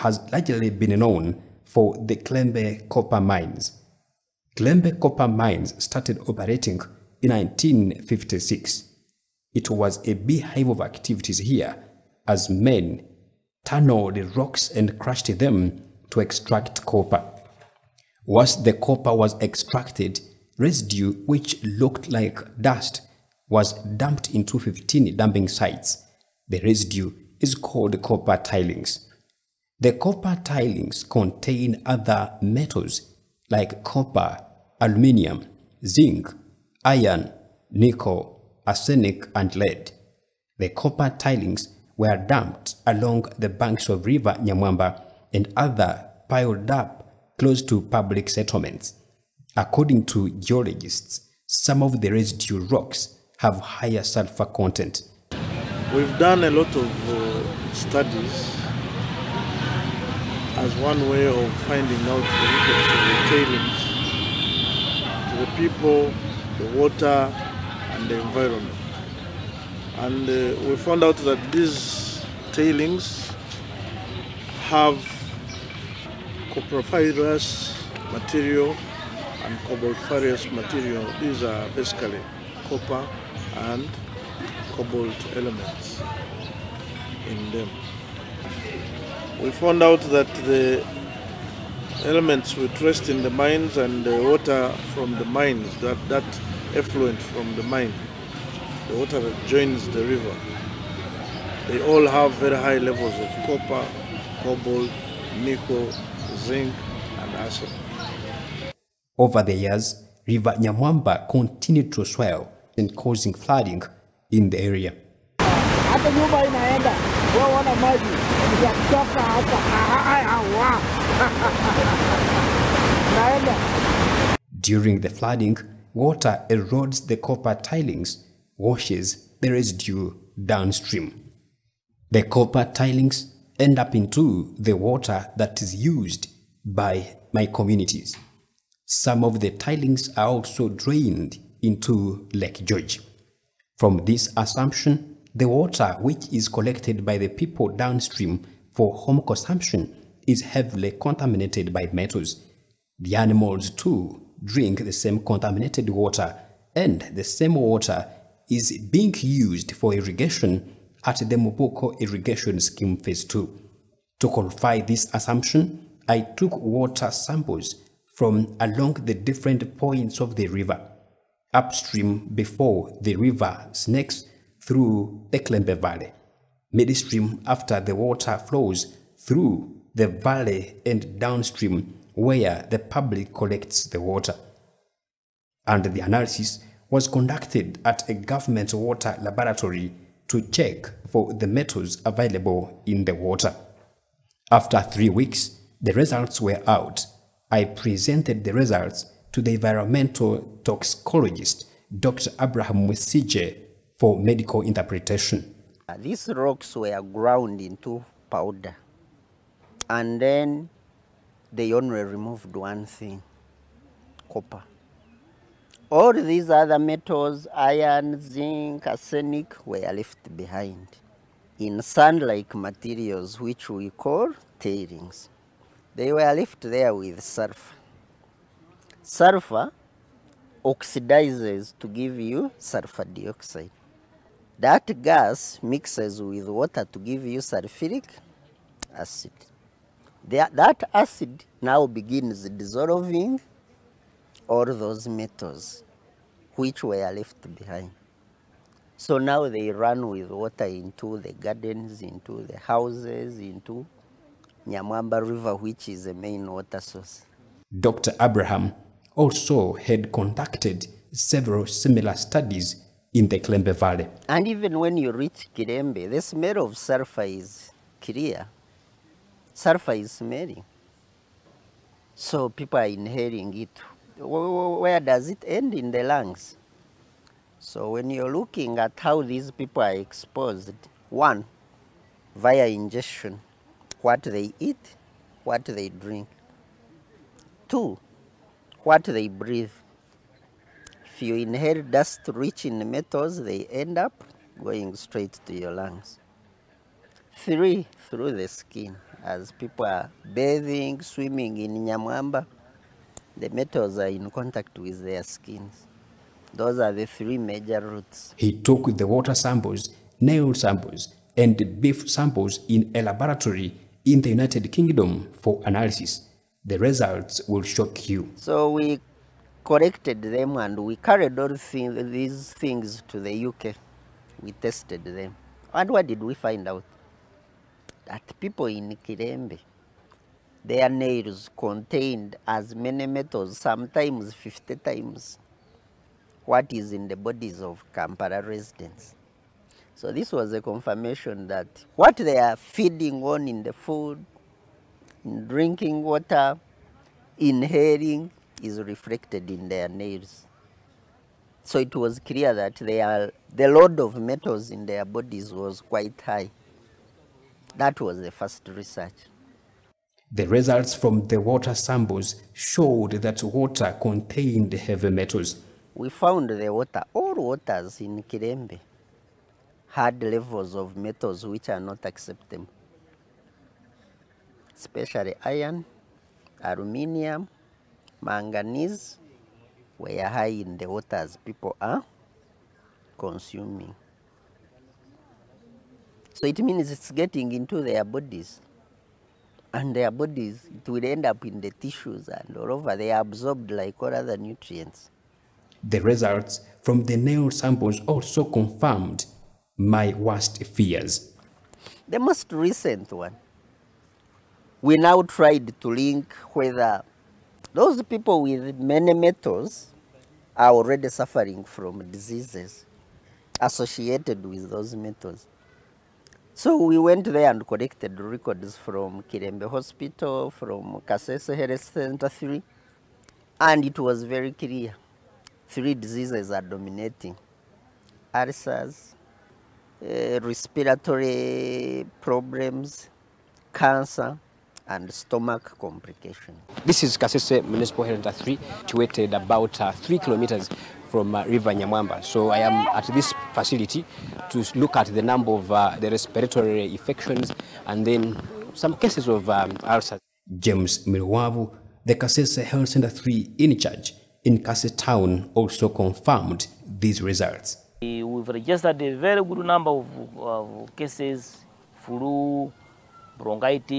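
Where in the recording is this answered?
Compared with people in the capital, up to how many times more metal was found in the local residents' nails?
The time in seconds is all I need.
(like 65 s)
334 s.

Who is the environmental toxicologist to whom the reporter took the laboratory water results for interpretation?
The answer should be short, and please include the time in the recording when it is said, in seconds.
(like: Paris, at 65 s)
Dr. Abraham Mwesigye, at 201 s.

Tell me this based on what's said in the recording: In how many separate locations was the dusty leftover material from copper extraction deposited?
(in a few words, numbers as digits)
15.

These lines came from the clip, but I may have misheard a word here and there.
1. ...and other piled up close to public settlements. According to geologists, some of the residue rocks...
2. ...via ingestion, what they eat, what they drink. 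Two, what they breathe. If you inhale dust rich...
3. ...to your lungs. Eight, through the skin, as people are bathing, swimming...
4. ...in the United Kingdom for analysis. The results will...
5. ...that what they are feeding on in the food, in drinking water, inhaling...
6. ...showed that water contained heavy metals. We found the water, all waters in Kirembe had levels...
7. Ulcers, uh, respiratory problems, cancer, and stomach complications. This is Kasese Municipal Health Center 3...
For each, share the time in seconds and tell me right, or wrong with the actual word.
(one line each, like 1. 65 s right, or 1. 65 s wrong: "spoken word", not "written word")
1. 45 s right
2. 282 s right
3. 295 s wrong: "Three", not "Eight"
4. 314 s right
5. 341 s right
6. 362 s right
7. 428 s right.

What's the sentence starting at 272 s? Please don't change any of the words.
So people are inhaling it where does it end in the lungs?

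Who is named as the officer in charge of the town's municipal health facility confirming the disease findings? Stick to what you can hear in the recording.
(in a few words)
James Mirwavu.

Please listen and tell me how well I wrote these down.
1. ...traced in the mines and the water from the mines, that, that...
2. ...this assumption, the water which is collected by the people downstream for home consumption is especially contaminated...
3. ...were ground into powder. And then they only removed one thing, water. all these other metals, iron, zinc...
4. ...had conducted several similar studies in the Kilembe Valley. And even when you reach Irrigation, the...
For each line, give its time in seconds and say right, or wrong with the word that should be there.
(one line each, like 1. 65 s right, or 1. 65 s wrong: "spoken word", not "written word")
1. 92 s right
2. 144 s wrong: "heavily", not "especially"
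3. 206 s wrong: "copper", not "water"
4. 259 s wrong: "Kirembe", not "Irrigation".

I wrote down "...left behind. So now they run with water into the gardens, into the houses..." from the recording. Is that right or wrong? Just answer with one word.
right.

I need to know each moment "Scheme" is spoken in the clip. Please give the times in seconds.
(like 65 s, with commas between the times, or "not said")
162 s.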